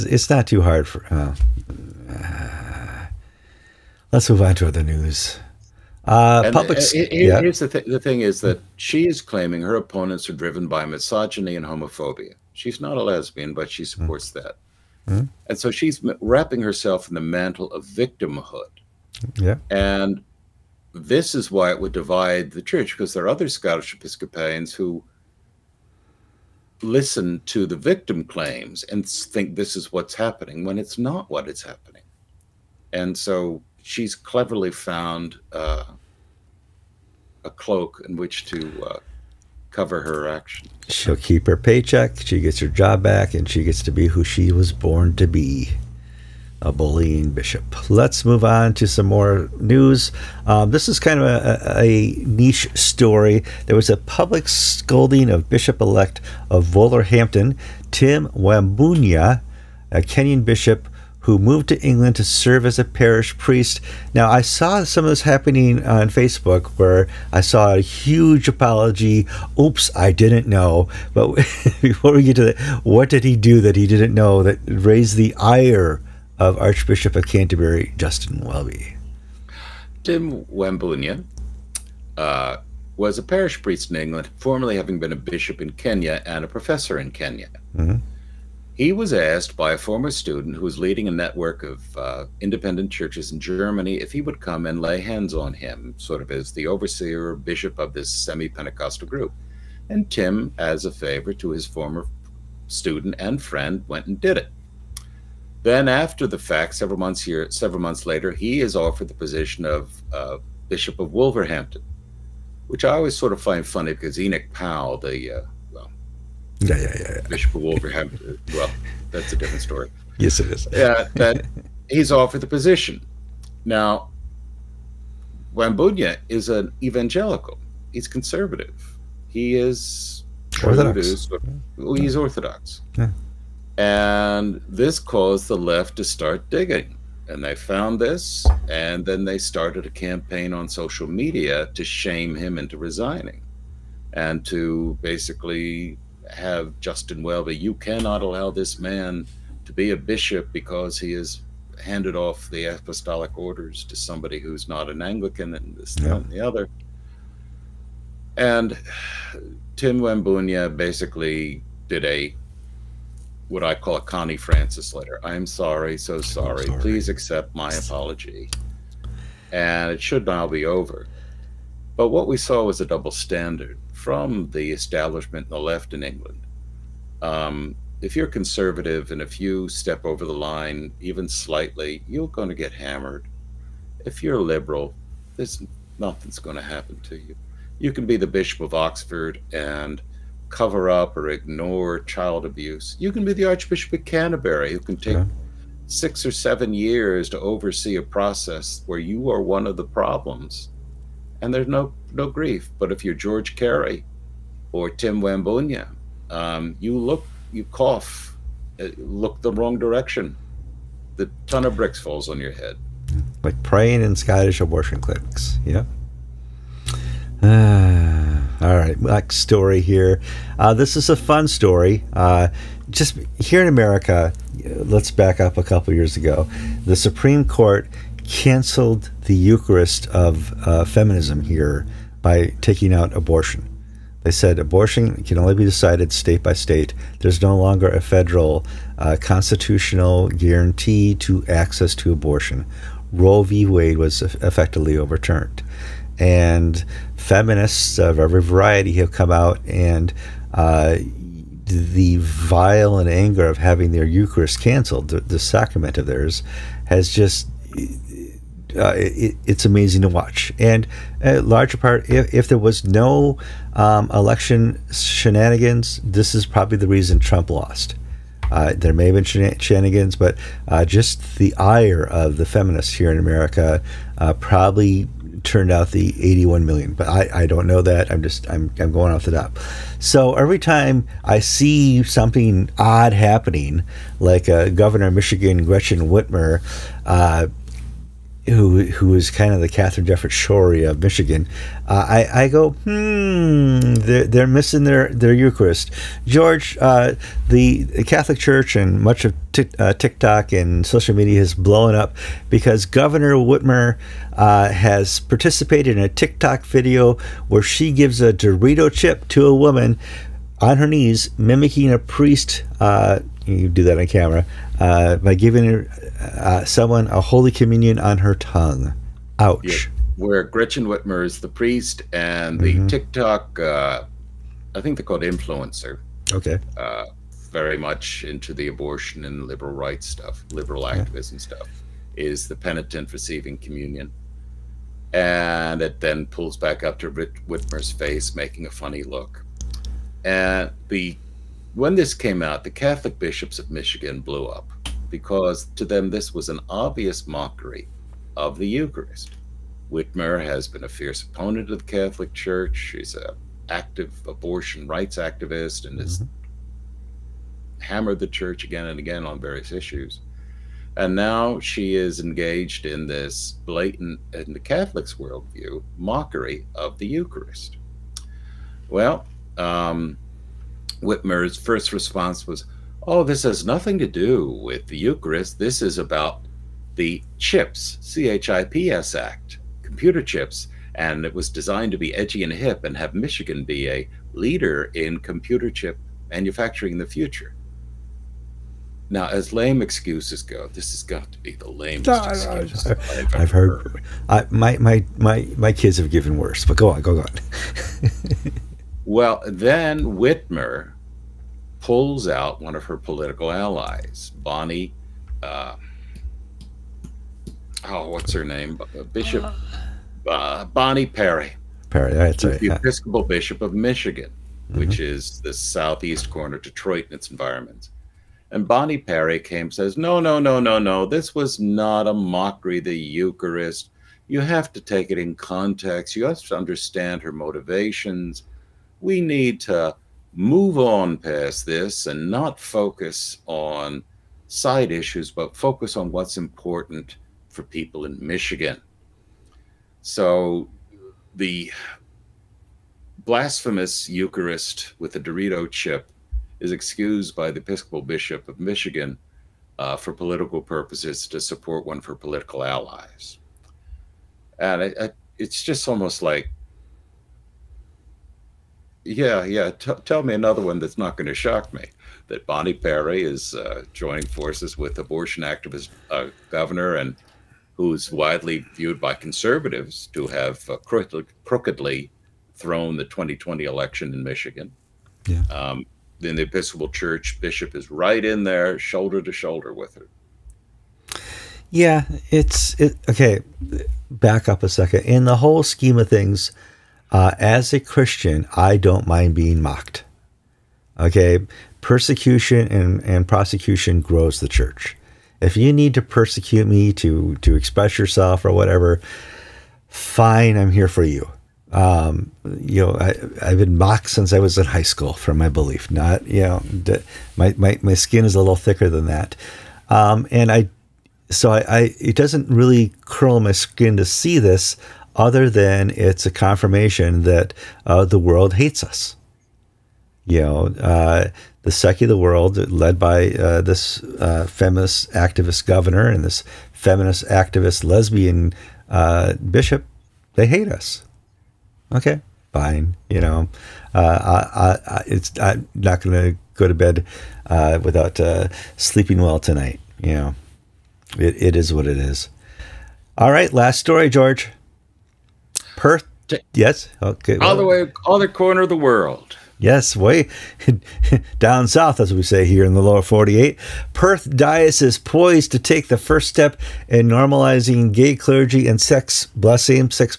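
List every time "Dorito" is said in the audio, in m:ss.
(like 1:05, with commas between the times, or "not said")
5:08, 7:25.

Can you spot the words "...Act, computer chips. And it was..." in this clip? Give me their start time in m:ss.
6:19.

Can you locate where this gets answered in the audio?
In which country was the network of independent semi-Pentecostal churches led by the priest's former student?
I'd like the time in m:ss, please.
1:33.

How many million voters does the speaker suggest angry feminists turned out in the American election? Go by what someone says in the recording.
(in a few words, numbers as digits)
81 million.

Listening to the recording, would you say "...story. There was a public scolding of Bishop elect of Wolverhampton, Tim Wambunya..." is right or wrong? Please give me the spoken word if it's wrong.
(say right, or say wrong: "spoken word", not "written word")
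right.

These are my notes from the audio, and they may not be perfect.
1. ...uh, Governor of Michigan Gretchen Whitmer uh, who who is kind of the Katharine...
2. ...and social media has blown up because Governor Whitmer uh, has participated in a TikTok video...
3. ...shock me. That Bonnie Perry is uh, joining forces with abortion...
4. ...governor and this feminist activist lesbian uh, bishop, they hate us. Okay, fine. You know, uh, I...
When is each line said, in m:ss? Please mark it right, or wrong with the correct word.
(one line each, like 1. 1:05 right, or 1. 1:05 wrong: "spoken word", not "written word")
1. 4:44 right
2. 5:00 right
3. 7:41 right
4. 8:45 right.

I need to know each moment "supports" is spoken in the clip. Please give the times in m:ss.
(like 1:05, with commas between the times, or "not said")
0:13, 7:31.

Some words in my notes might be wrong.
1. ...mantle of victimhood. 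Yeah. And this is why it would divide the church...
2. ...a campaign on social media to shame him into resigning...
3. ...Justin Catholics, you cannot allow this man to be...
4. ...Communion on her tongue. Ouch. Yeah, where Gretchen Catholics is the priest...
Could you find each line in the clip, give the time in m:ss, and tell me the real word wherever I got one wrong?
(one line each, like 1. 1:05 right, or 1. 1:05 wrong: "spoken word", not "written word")
1. 0:17 right
2. 2:19 right
3. 2:26 wrong: "Welby", not "Catholics"
4. 5:17 wrong: "Whitmer", not "Catholics".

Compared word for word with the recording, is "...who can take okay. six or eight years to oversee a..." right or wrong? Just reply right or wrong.
wrong.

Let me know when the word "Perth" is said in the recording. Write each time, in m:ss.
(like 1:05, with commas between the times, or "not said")
9:05, 9:13.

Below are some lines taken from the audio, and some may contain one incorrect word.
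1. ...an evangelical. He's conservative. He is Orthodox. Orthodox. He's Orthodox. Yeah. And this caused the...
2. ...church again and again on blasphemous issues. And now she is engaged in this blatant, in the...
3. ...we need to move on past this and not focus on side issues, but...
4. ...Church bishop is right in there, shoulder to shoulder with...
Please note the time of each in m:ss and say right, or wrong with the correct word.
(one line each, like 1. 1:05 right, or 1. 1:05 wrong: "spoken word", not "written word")
1. 2:06 right
2. 5:58 wrong: "various", not "blasphemous"
3. 7:09 right
4. 7:56 right.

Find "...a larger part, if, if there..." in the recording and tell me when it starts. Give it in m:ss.
4:21.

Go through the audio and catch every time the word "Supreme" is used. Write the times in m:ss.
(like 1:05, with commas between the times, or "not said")
3:46.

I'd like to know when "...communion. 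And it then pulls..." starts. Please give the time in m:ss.
5:33.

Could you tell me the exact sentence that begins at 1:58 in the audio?
Uh, well, that's a different story.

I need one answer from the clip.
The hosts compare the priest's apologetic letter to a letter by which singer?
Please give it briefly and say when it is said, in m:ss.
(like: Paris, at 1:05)
Connie Francis, at 2:44.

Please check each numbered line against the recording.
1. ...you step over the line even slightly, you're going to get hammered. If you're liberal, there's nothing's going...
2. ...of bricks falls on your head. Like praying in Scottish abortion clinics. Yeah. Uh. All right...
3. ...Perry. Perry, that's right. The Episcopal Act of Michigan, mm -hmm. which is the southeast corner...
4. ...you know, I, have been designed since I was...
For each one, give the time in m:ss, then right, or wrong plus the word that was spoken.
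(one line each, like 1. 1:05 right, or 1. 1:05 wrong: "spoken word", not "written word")
1. 2:59 right
2. 3:31 right
3. 6:51 wrong: "Bishop", not "Act"
4. 8:22 wrong: "mocked", not "designed".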